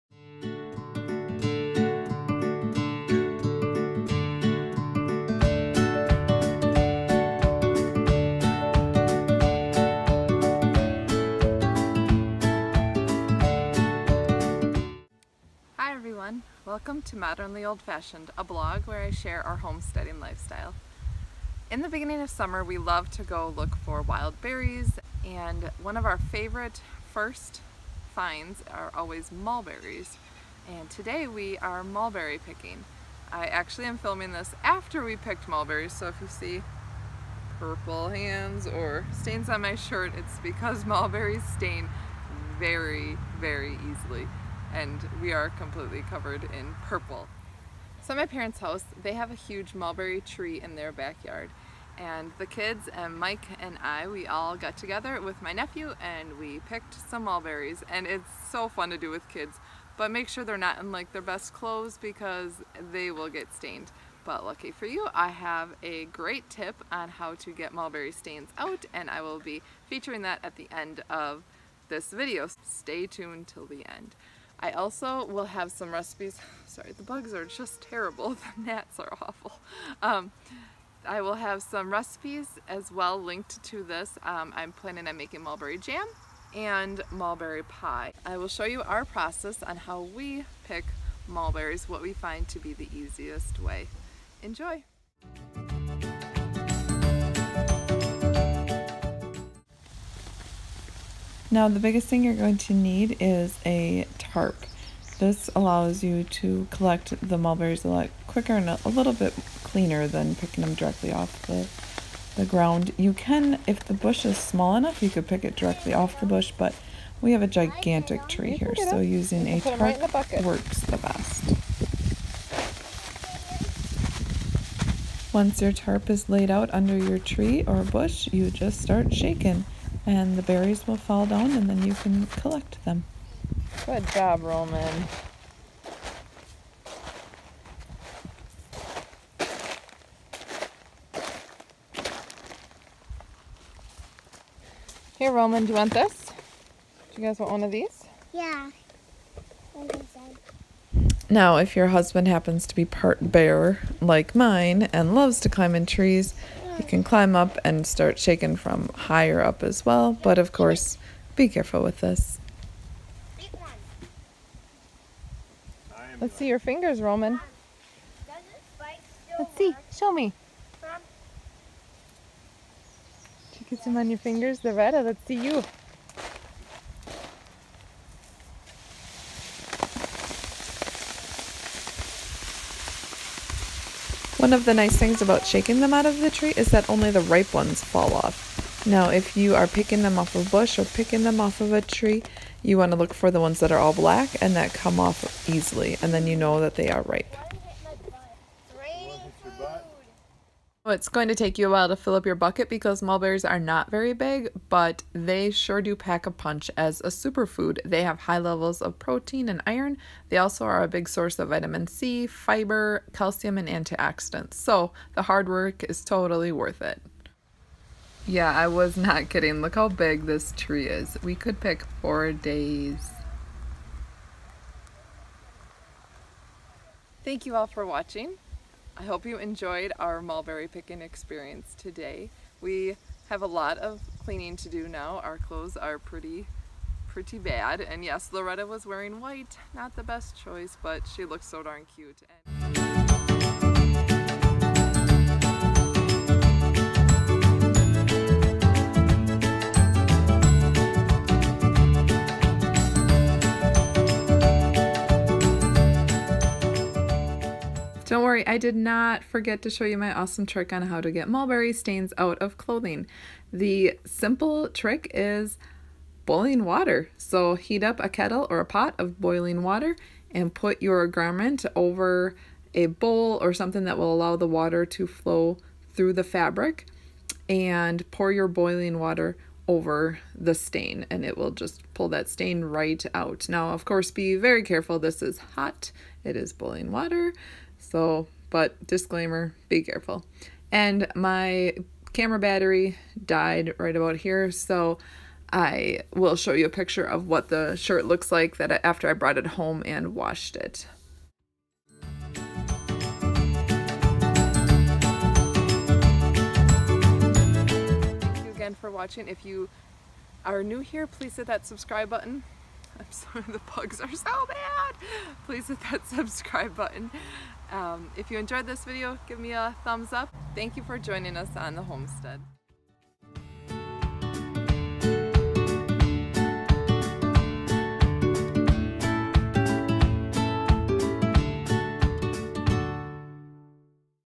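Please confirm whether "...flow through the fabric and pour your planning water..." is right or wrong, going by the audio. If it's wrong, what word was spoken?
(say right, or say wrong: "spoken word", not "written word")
wrong: "boiling", not "planning".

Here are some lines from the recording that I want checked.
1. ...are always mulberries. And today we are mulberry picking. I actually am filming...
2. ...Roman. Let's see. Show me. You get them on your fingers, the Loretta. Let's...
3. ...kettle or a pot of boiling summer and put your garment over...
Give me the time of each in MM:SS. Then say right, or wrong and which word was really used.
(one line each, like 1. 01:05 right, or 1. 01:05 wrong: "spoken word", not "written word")
1. 00:28 right
2. 02:47 right
3. 04:28 wrong: "water", not "summer".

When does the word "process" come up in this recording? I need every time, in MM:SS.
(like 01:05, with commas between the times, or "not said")
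01:29.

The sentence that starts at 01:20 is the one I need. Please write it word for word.
Um, I will have some recipes as well linked to this.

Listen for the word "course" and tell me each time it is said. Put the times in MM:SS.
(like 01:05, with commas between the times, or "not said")
02:40, 04:43.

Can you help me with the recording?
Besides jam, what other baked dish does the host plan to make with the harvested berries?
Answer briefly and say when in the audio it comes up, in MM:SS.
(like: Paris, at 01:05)
Mulberry pie, at 01:27.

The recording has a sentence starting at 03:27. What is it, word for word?
They have high levels of protein and iron.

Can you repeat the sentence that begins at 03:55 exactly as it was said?
Our clothes are pretty pretty bad.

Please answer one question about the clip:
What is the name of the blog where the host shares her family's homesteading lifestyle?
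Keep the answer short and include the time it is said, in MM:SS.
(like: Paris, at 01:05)
Modernly Old Fashioned, at 00:17.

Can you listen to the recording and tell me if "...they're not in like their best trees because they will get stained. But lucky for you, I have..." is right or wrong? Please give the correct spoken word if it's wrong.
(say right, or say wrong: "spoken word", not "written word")
wrong: "clothes", not "trees".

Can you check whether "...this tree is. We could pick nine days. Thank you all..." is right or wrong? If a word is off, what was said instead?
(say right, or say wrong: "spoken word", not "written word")
wrong: "four", not "nine".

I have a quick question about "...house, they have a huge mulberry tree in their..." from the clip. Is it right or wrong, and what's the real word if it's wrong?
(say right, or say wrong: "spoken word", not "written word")
right.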